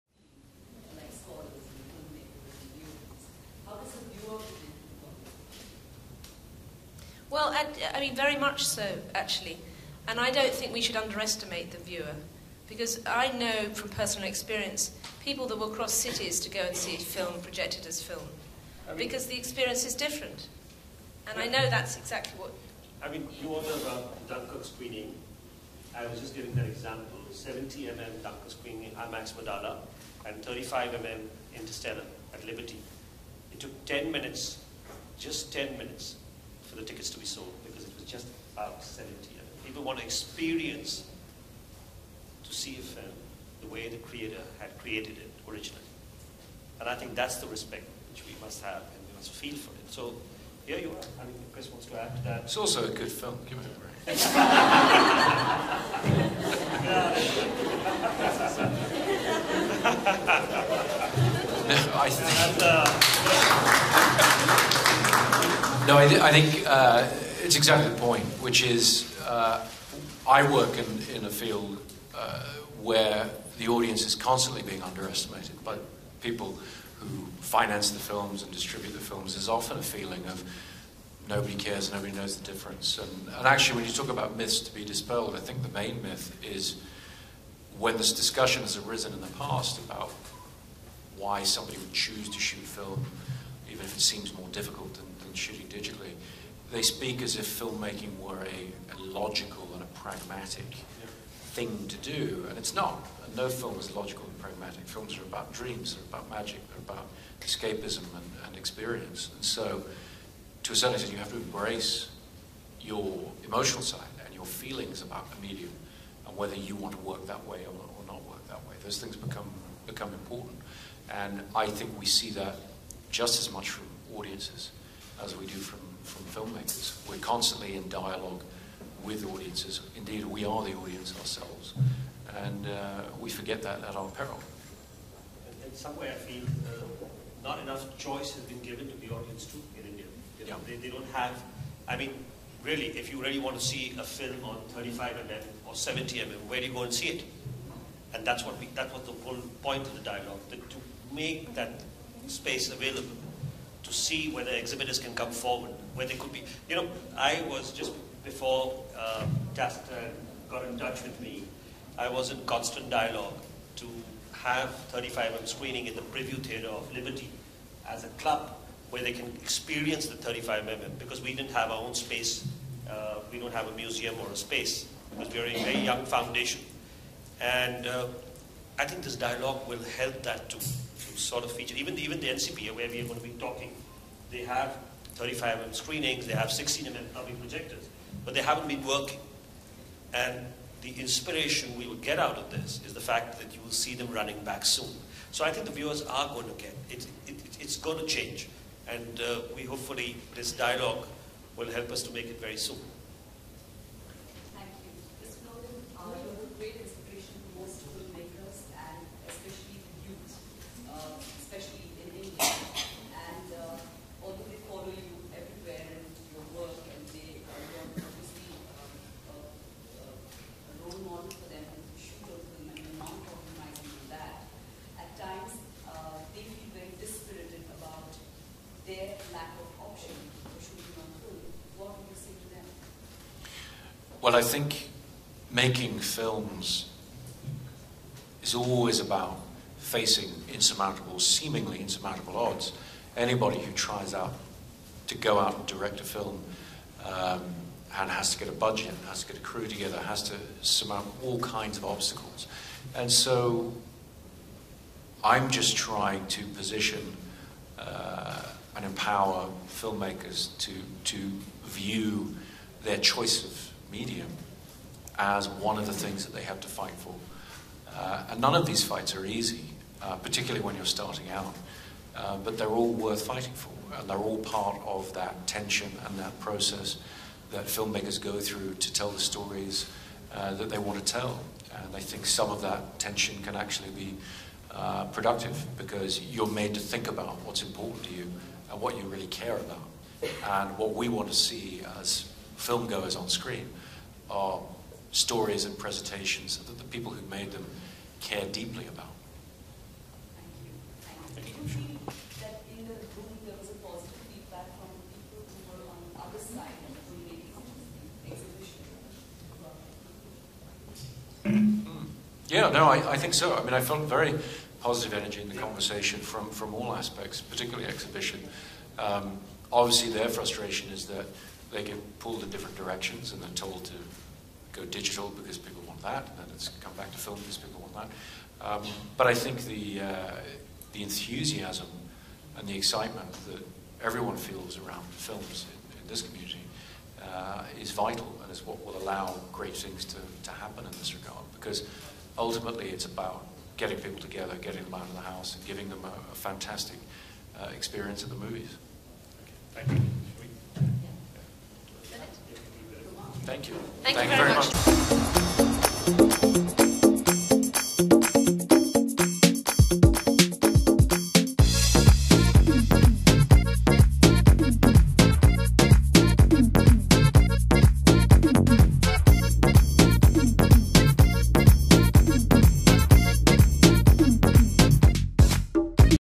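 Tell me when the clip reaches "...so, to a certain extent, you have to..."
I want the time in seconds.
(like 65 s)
109 s.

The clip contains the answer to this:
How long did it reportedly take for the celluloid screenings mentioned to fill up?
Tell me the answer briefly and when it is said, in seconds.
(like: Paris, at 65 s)
10 minutes, at 35 s.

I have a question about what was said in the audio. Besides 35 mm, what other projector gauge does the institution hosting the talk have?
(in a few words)
16 mm.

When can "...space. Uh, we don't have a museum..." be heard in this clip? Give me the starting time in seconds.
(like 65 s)
171 s.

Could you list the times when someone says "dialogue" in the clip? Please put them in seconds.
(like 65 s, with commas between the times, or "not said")
127 s, 150 s, 162 s, 179 s, 200 s.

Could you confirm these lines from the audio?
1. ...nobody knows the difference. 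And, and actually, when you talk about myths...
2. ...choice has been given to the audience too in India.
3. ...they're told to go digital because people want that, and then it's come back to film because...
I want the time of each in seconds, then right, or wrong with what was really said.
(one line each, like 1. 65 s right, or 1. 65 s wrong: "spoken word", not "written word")
1. 81 s right
2. 137 s right
3. 323 s right.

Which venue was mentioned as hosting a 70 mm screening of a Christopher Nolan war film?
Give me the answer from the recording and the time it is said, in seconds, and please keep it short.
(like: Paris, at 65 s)
IMAX Wadala, at 29 s.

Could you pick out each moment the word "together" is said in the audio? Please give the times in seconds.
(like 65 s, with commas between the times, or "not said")
249 s, 344 s.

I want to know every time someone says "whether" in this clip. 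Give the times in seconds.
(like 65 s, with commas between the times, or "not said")
116 s, 154 s.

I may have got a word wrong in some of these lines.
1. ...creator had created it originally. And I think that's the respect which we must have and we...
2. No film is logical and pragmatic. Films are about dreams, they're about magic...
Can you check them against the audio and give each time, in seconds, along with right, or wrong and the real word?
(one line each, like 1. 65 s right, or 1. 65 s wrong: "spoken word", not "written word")
1. 43 s right
2. 103 s right.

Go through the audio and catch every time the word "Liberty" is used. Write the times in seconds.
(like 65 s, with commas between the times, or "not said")
32 s, 166 s.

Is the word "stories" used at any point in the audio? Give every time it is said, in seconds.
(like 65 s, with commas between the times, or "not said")
279 s, 295 s.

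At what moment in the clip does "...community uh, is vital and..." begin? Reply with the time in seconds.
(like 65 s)
336 s.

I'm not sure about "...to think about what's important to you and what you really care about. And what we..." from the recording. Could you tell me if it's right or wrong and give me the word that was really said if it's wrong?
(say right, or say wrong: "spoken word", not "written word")
right.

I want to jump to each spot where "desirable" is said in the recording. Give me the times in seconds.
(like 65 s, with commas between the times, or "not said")
not said.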